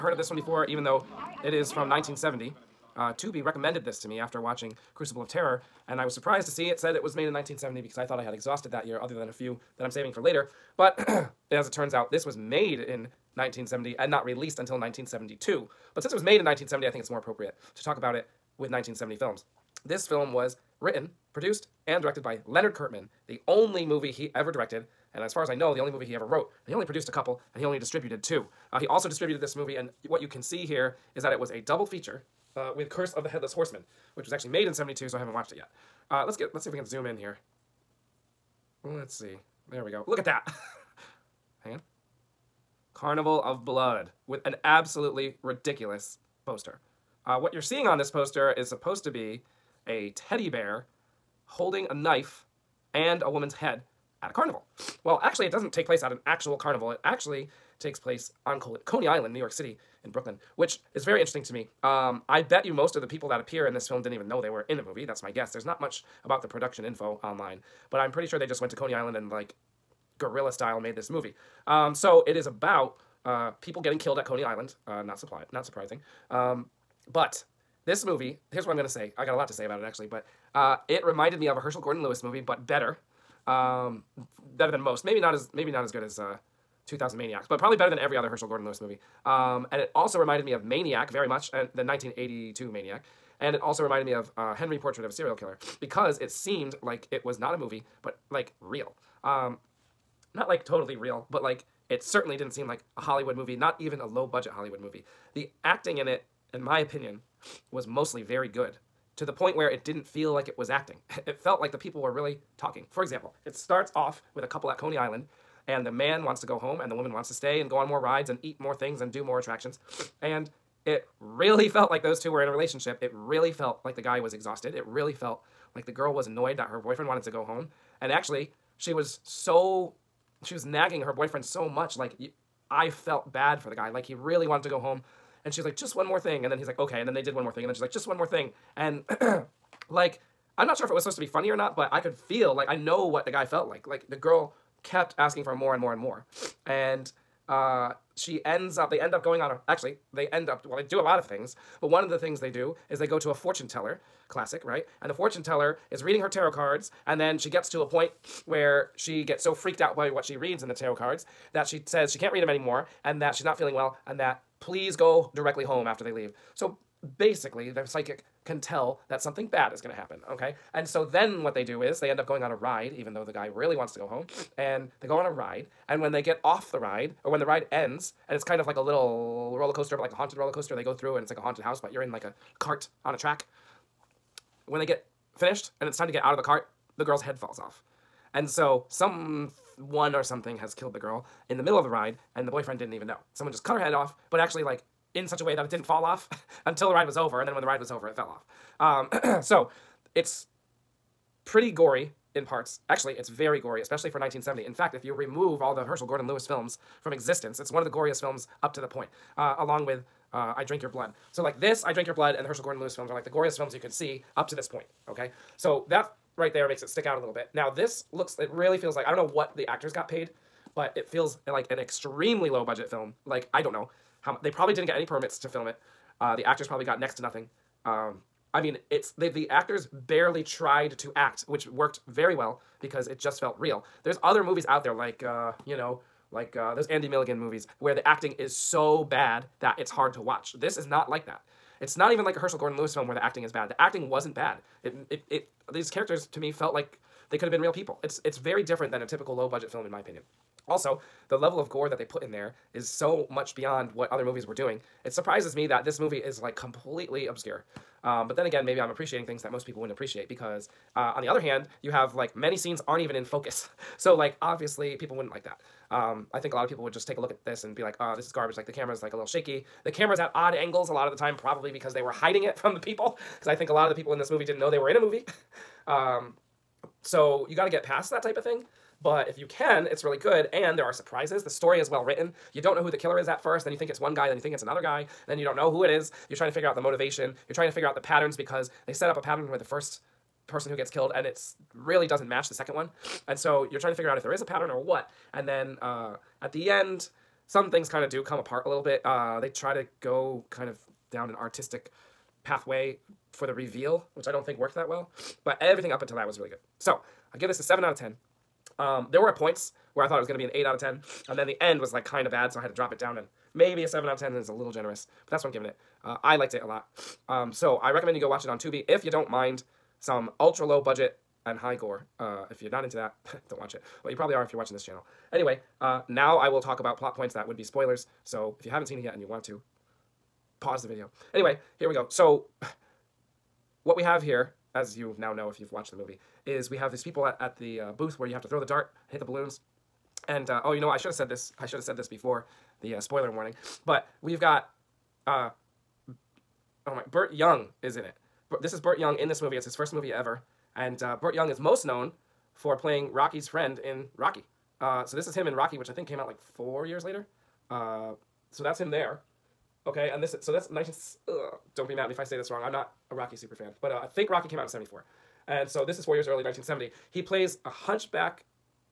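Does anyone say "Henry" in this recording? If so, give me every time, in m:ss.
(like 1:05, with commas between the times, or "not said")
1:34.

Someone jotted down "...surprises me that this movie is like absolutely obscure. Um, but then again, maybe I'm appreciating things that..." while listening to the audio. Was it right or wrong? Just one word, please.
wrong.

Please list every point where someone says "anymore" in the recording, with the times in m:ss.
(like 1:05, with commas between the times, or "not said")
2:42.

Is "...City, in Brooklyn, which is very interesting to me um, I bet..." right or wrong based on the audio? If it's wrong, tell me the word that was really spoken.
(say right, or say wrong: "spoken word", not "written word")
right.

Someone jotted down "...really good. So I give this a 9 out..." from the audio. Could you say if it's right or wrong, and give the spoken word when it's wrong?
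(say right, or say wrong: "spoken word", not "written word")
wrong: "7", not "9".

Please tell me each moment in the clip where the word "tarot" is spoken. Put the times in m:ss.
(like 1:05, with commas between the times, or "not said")
2:36, 2:40.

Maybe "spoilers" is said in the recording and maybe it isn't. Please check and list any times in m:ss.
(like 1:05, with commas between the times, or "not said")
5:27, 5:43.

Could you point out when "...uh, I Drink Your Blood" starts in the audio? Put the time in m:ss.
3:30.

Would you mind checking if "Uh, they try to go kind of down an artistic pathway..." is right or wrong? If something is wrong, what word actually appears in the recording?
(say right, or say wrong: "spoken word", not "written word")
right.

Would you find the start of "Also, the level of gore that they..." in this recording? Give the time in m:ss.
4:10.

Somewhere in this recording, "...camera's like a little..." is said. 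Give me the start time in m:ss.
4:28.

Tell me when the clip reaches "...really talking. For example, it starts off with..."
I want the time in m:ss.
1:52.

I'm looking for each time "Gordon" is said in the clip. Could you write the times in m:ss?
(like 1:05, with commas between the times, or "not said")
1:21, 1:28, 3:26, 3:32, 4:02.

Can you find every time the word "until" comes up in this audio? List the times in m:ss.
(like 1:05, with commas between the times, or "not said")
0:14, 3:16, 5:06.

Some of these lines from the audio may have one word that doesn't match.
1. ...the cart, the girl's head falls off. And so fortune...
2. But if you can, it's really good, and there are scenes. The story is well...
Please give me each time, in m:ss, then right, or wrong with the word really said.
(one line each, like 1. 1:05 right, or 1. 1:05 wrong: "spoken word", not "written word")
1. 3:06 wrong: "someone", not "fortune"
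2. 4:39 wrong: "surprises", not "scenes".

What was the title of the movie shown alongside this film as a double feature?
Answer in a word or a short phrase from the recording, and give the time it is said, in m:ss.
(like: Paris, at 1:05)
Curse of the Headless Horseman, at 0:32.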